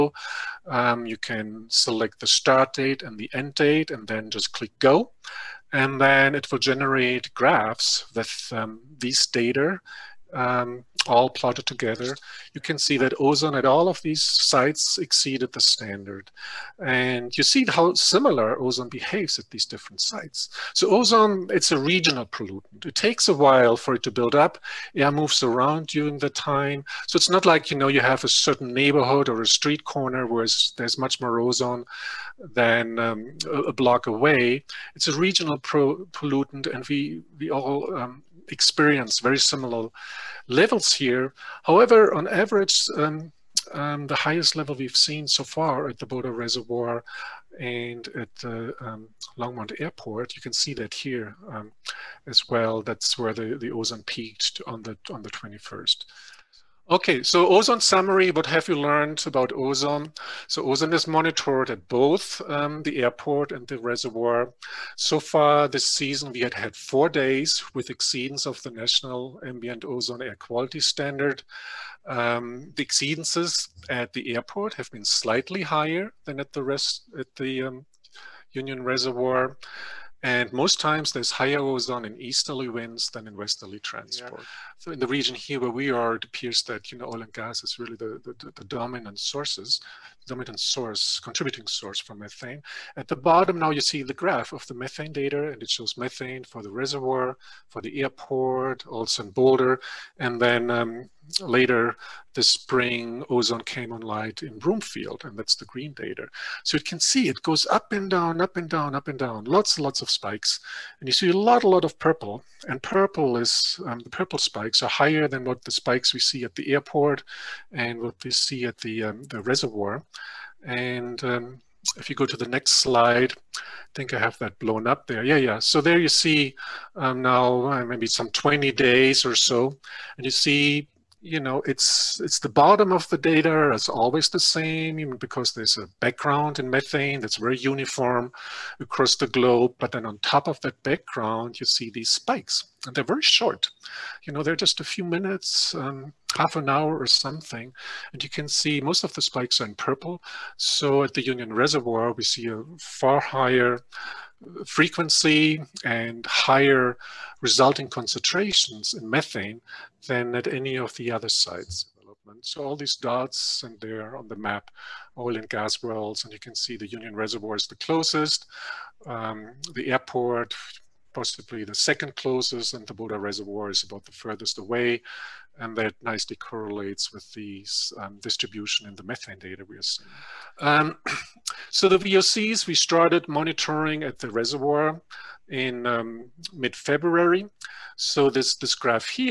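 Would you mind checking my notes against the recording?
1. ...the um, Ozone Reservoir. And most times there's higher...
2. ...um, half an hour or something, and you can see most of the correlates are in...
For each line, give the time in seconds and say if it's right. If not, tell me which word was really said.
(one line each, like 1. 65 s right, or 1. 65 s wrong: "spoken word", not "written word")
1. 77 s wrong: "Union", not "Ozone"
2. 145 s wrong: "spikes", not "correlates".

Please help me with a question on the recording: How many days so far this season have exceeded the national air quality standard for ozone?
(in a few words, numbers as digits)
4.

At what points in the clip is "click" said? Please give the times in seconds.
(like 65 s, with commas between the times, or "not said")
4 s.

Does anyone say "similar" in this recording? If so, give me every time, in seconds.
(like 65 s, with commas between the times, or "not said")
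17 s, 39 s.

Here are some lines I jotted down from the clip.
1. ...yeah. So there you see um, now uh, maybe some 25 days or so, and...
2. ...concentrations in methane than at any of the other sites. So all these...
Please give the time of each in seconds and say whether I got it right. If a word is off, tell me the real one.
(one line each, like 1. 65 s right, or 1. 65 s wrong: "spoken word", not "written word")
1. 125 s wrong: "20", not "25"
2. 157 s right.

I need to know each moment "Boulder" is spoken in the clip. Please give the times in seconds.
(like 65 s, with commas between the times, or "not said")
46 s, 99 s.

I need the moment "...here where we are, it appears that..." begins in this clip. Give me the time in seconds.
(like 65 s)
85 s.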